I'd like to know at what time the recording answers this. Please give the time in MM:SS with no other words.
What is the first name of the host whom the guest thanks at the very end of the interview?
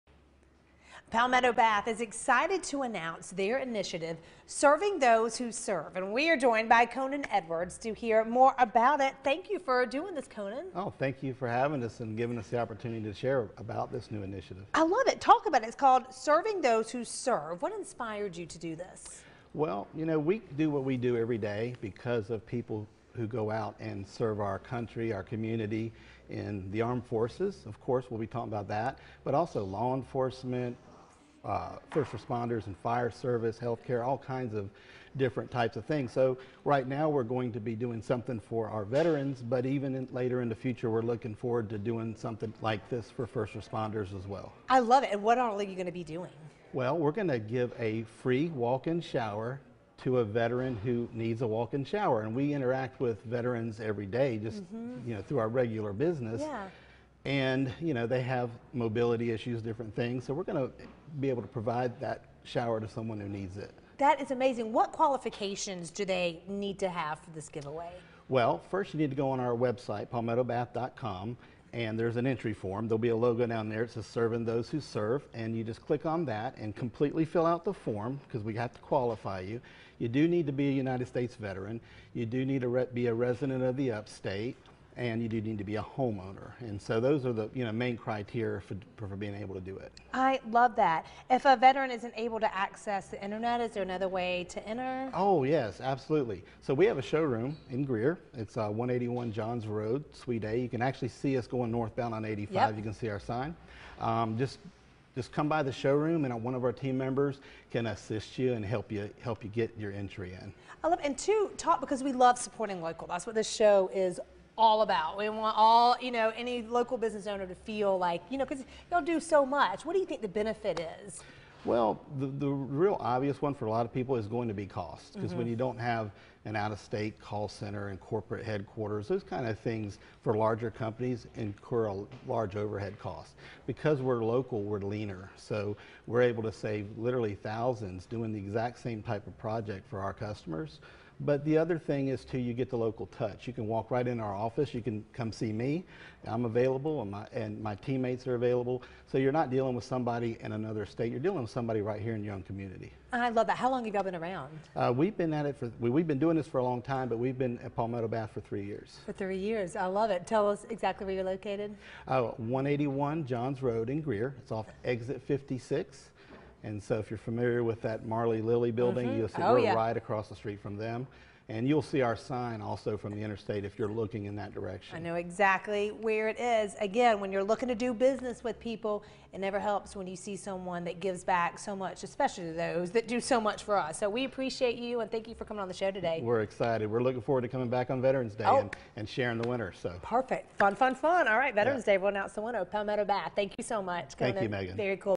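03:14.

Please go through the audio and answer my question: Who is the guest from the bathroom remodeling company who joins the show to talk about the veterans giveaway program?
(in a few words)
Conan Edwards.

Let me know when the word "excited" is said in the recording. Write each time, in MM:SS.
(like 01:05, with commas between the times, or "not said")
00:01, 03:06.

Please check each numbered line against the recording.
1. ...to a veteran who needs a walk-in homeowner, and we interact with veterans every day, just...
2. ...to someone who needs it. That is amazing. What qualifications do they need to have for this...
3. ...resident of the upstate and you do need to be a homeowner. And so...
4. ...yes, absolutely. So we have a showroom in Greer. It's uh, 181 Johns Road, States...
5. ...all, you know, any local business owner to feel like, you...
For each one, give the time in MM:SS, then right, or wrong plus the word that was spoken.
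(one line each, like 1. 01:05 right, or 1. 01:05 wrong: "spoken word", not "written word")
1. 00:50 wrong: "shower", not "homeowner"
2. 01:02 right
3. 01:23 right
4. 01:35 wrong: "Suite", not "States"
5. 01:55 right.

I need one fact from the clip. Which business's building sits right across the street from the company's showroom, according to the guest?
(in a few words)
Marley Lilly.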